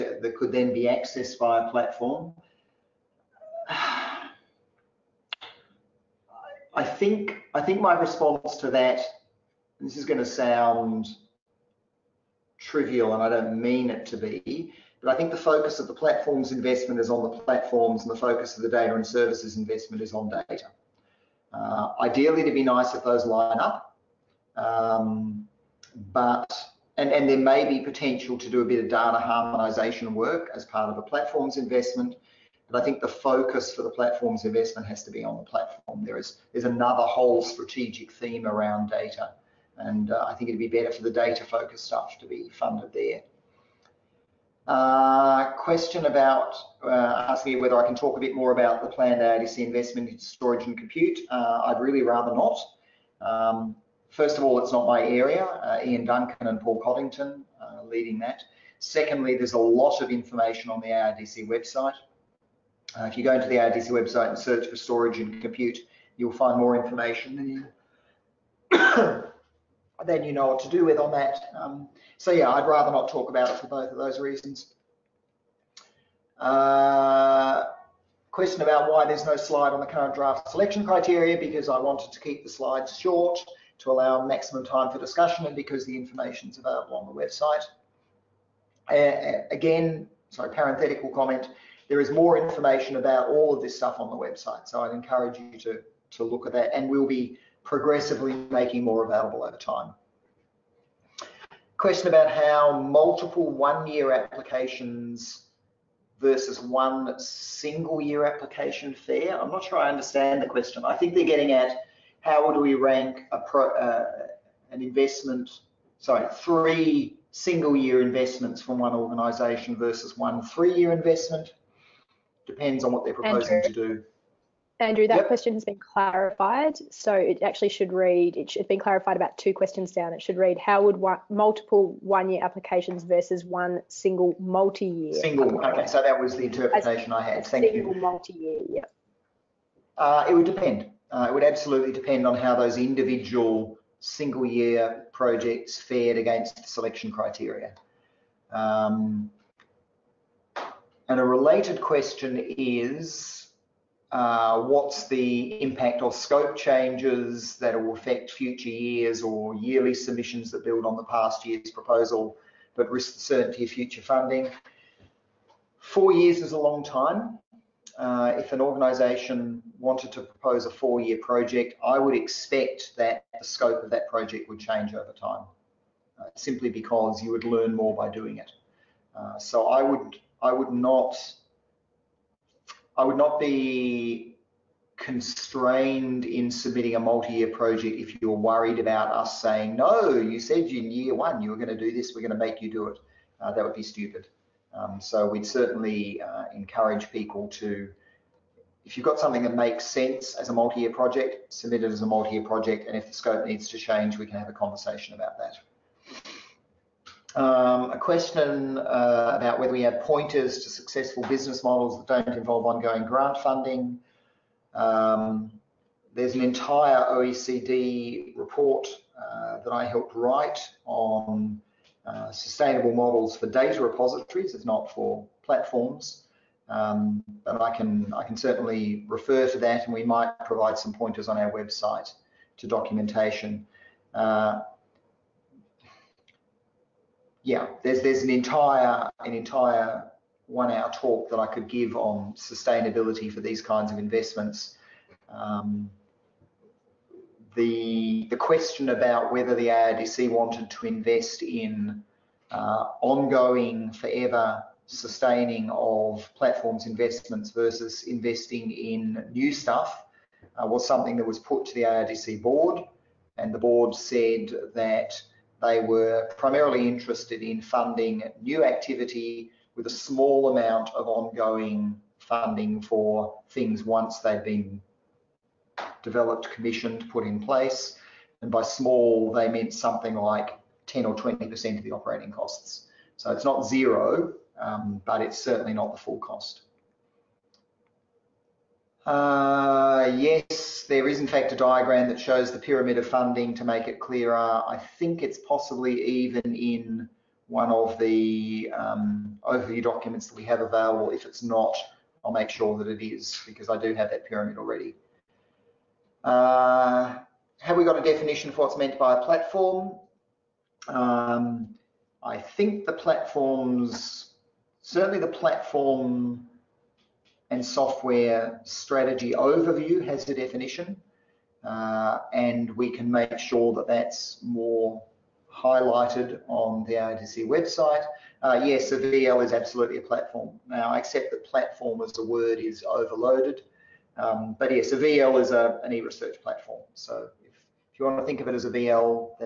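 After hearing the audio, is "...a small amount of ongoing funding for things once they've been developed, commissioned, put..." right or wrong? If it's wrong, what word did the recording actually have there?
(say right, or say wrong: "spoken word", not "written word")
right.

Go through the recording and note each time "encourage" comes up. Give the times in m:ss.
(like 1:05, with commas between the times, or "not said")
1:34, 3:16.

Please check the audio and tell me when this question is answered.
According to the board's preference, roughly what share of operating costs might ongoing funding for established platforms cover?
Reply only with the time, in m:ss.
4:40.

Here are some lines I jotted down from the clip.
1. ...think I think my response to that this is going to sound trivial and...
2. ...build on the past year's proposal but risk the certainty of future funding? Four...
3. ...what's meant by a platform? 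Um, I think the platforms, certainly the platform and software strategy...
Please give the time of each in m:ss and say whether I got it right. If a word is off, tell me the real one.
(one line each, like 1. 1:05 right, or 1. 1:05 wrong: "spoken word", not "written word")
1. 0:06 right
2. 2:40 right
3. 5:08 right.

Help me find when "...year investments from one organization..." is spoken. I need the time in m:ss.
1:57.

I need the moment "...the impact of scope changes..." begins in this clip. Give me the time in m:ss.
2:35.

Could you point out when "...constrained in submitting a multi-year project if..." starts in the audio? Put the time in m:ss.
3:04.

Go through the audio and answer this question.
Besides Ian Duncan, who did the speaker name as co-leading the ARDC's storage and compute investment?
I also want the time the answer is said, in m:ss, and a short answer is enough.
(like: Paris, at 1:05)
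Paul Coddington, at 0:56.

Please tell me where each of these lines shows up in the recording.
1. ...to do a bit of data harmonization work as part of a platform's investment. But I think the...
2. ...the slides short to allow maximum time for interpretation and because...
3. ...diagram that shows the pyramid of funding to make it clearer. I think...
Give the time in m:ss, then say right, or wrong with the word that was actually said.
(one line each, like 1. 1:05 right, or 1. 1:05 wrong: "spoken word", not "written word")
1. 0:28 right
2. 1:22 wrong: "discussion", not "interpretation"
3. 4:51 right.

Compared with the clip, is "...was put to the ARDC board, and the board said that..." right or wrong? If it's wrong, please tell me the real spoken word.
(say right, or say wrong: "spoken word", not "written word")
right.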